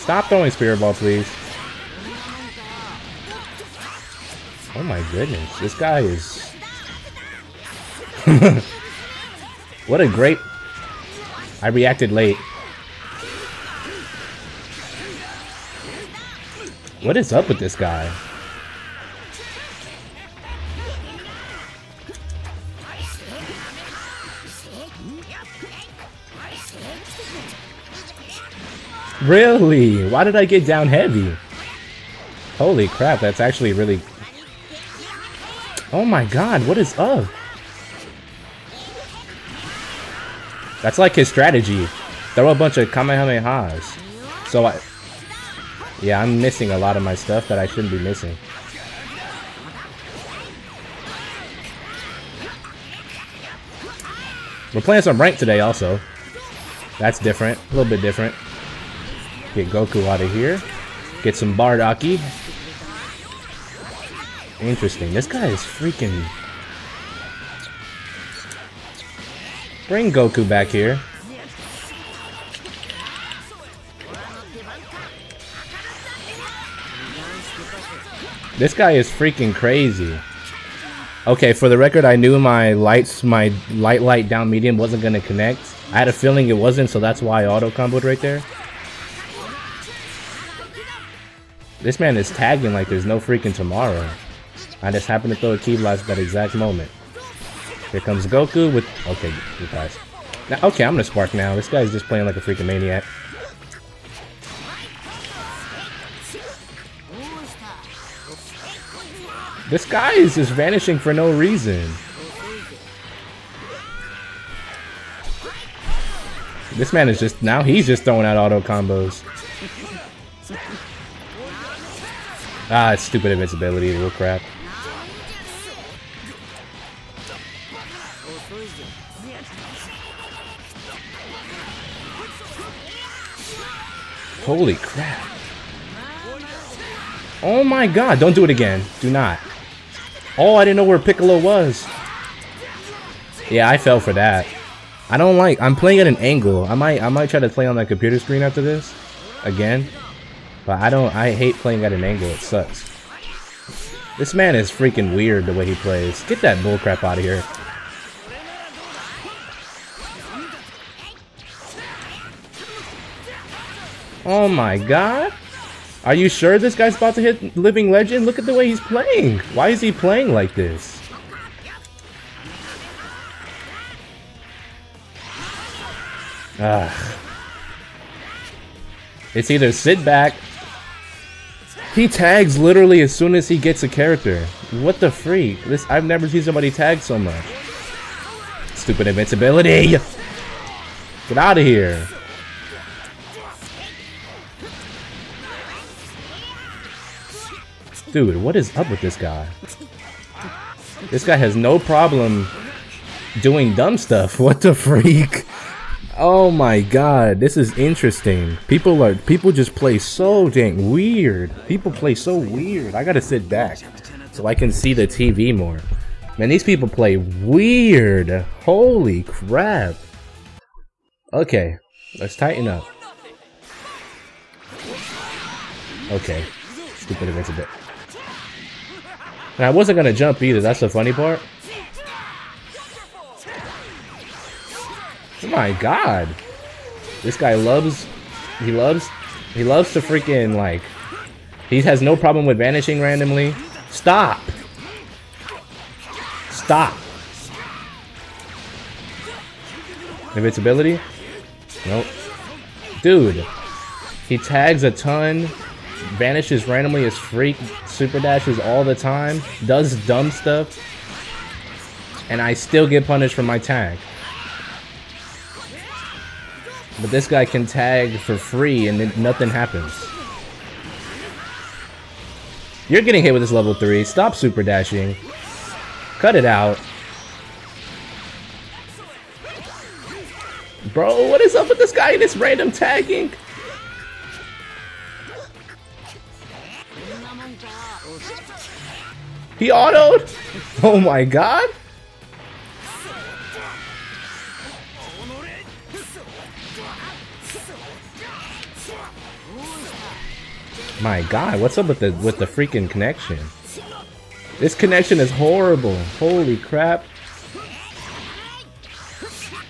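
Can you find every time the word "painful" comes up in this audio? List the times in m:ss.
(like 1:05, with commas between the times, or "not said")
not said.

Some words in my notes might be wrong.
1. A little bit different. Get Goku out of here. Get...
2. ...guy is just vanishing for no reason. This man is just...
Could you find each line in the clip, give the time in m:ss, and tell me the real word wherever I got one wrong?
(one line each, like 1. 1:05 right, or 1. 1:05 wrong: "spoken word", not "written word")
1. 0:57 right
2. 1:49 right.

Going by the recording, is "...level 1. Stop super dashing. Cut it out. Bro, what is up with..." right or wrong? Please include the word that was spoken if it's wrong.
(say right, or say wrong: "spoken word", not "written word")
wrong: "3", not "1".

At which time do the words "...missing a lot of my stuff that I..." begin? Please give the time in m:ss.
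0:46.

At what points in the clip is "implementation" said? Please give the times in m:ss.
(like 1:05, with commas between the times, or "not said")
not said.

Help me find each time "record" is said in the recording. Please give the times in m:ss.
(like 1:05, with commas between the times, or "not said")
1:21.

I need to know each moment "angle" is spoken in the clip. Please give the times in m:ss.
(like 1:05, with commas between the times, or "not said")
2:26, 2:32.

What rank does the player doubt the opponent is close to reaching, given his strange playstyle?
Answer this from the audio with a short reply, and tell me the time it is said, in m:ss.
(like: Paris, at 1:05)
Living Legend, at 2:47.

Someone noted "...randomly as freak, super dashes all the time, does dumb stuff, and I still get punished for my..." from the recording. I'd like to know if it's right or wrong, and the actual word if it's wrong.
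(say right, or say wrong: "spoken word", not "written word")
right.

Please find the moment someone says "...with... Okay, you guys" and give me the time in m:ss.
1:38.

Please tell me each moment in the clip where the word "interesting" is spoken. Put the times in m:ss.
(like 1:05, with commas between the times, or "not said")
1:04, 3:27.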